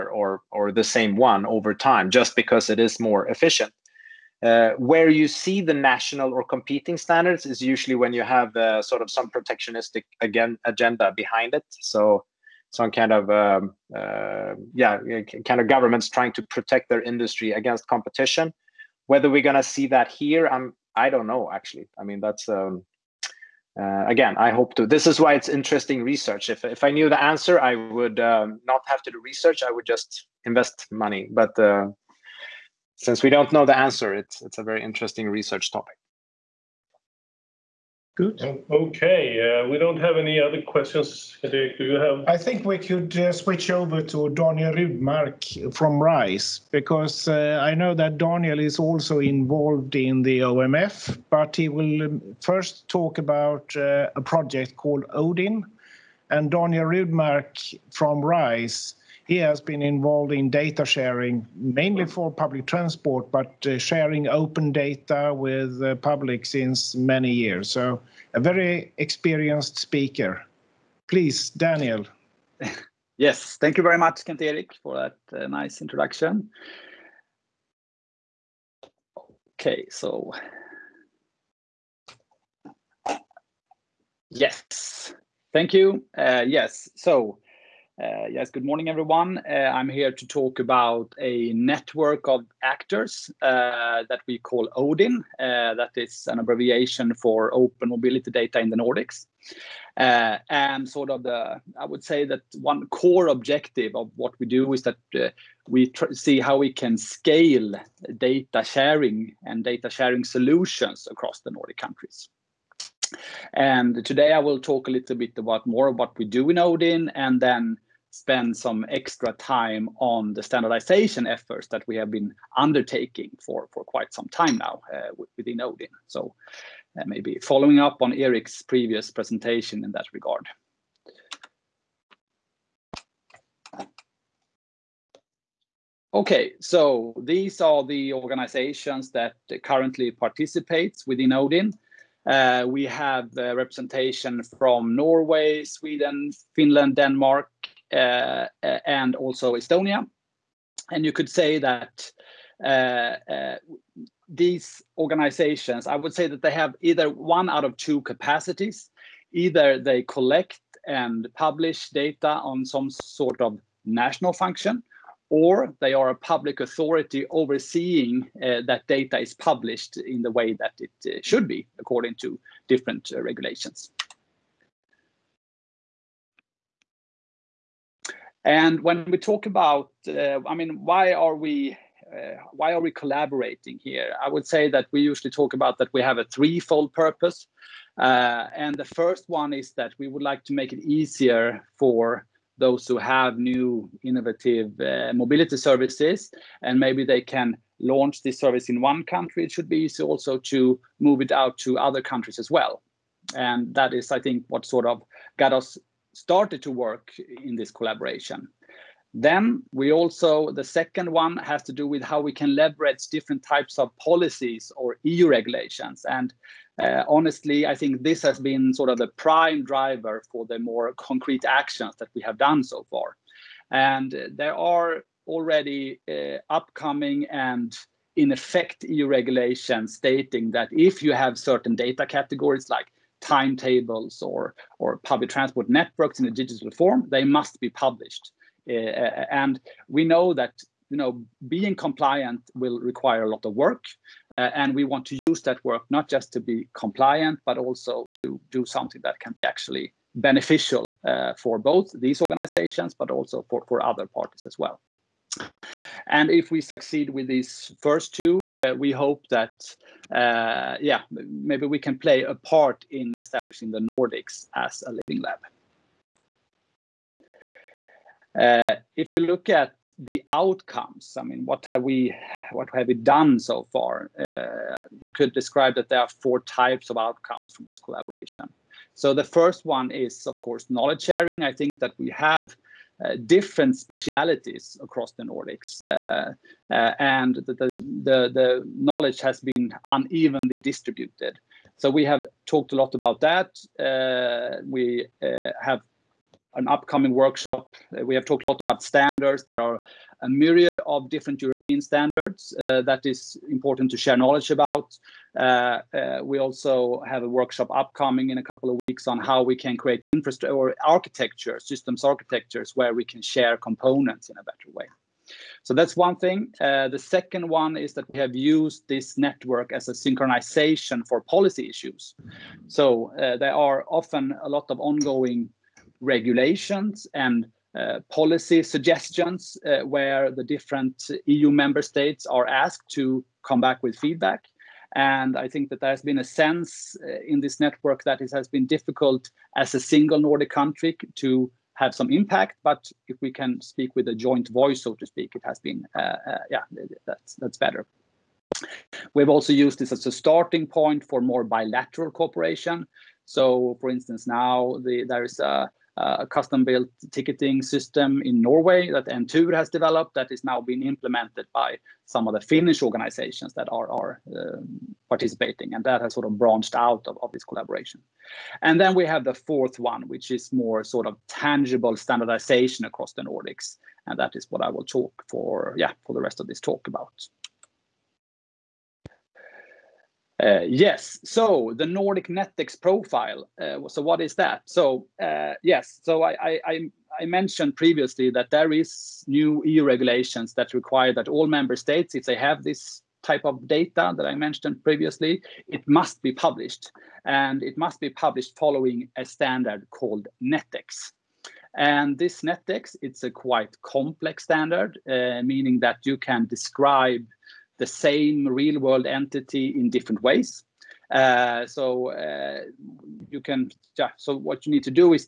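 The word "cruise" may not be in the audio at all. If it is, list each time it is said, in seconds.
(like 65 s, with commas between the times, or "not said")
not said.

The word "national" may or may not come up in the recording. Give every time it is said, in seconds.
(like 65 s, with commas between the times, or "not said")
5 s, 163 s.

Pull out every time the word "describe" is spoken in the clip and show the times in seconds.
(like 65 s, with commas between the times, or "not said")
275 s, 406 s.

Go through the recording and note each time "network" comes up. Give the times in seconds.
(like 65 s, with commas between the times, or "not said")
91 s, 235 s, 319 s, 337 s.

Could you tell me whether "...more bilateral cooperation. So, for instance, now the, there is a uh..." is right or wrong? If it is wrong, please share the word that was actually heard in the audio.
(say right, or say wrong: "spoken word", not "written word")
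right.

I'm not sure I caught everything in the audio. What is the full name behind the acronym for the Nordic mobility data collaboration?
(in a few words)
Open Mobility Data in the Nordics.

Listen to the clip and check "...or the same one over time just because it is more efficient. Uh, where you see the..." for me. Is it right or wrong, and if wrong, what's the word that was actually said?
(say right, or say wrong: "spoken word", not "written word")
right.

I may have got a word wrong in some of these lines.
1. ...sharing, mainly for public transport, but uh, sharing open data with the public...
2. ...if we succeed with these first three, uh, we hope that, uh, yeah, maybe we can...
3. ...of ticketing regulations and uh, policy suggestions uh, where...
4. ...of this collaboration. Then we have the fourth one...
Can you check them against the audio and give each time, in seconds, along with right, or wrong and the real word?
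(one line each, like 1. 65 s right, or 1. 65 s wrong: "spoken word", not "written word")
1. 60 s right
2. 256 s wrong: "two", not "three"
3. 324 s wrong: "ongoing", not "ticketing"
4. 367 s right.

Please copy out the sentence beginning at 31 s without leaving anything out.
But uh, since we don't know the answer, it's it's a very interesting research topic.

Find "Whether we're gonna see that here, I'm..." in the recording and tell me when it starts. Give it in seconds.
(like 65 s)
19 s.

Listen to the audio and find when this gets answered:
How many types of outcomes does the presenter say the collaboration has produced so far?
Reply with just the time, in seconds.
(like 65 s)
276 s.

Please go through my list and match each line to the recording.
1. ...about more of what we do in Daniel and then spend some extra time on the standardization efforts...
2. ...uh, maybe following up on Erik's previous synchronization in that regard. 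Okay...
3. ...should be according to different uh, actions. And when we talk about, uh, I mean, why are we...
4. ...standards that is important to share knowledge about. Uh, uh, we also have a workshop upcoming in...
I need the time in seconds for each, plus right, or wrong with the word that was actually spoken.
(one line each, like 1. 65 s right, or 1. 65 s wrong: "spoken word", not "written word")
1. 115 s wrong: "Odin", not "Daniel"
2. 126 s wrong: "presentation", not "synchronization"
3. 171 s wrong: "regulations", not "actions"
4. 301 s right.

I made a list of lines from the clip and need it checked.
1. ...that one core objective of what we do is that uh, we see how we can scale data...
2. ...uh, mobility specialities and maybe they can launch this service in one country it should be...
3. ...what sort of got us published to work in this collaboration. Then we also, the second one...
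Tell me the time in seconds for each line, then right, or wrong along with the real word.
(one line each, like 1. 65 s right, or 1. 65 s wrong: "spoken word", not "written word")
1. 102 s right
2. 194 s wrong: "services", not "specialities"
3. 204 s wrong: "started", not "published".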